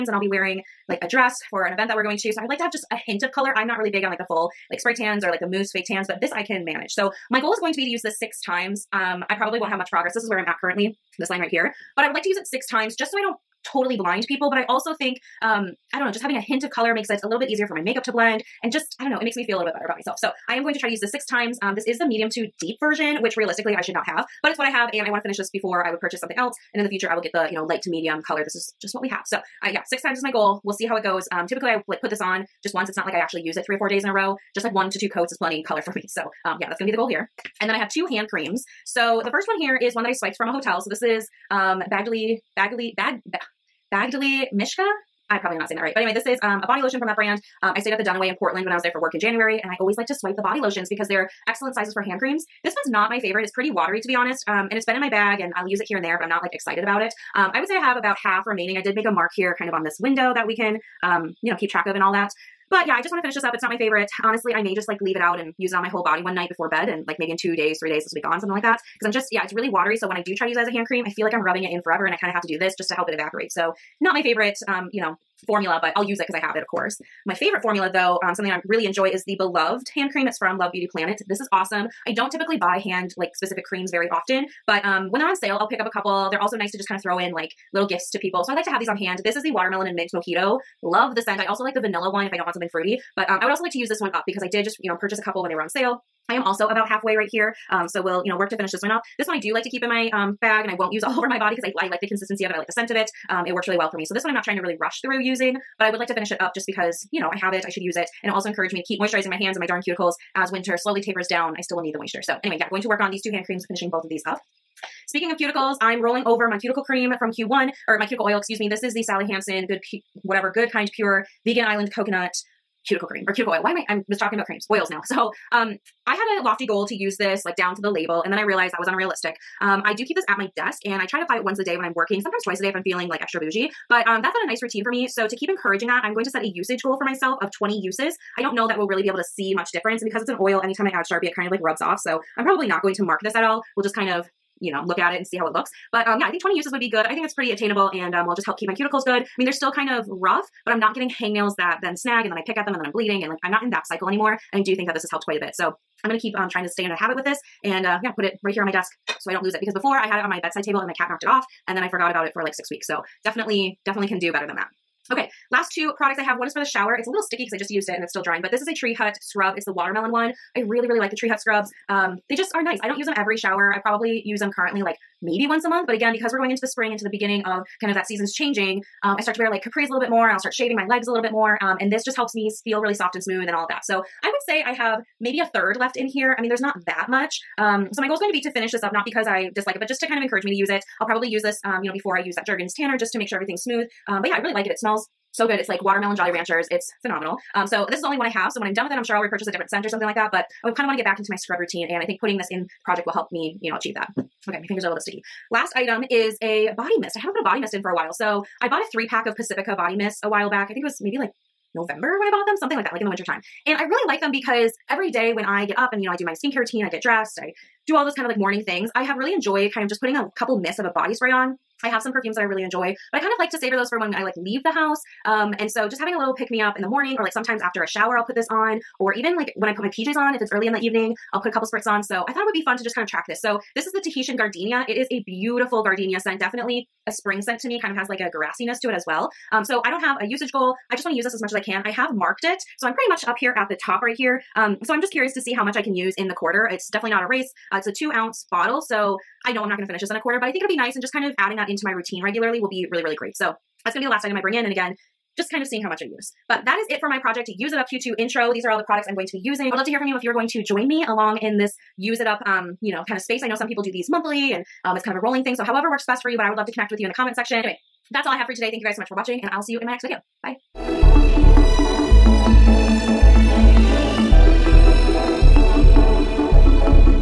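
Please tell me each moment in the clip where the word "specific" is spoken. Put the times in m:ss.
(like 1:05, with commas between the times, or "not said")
1:23.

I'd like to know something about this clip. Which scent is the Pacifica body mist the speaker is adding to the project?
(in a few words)
Tahitian gardenia.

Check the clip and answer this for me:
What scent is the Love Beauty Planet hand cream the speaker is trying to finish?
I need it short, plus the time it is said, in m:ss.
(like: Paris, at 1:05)
Watermelon and mint mojito, at 1:29.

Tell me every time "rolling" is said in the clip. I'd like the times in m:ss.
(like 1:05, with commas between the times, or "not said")
1:56, 4:25.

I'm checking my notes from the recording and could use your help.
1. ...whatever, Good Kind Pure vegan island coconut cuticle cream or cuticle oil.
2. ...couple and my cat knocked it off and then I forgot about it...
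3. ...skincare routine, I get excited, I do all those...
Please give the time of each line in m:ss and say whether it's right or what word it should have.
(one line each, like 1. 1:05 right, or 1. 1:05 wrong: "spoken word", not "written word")
1. 2:00 right
2. 2:40 wrong: "table", not "couple"
3. 3:36 wrong: "dressed", not "excited".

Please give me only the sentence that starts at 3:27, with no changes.
I haven't put a body mist in for a while.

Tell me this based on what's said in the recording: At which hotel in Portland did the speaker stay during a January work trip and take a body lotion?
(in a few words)
The Duniway.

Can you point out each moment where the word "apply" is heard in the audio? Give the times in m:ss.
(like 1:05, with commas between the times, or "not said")
2:11.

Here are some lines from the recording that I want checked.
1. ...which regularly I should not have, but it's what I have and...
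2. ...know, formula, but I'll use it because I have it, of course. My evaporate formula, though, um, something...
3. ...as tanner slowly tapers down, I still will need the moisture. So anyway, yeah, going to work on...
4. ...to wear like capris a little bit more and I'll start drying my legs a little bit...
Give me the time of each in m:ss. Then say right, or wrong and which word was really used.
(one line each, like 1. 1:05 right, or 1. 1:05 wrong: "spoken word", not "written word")
1. 0:23 wrong: "realistically", not "regularly"
2. 1:15 wrong: "favorite", not "evaporate"
3. 1:50 wrong: "winter", not "tanner"
4. 2:59 wrong: "shaving", not "drying".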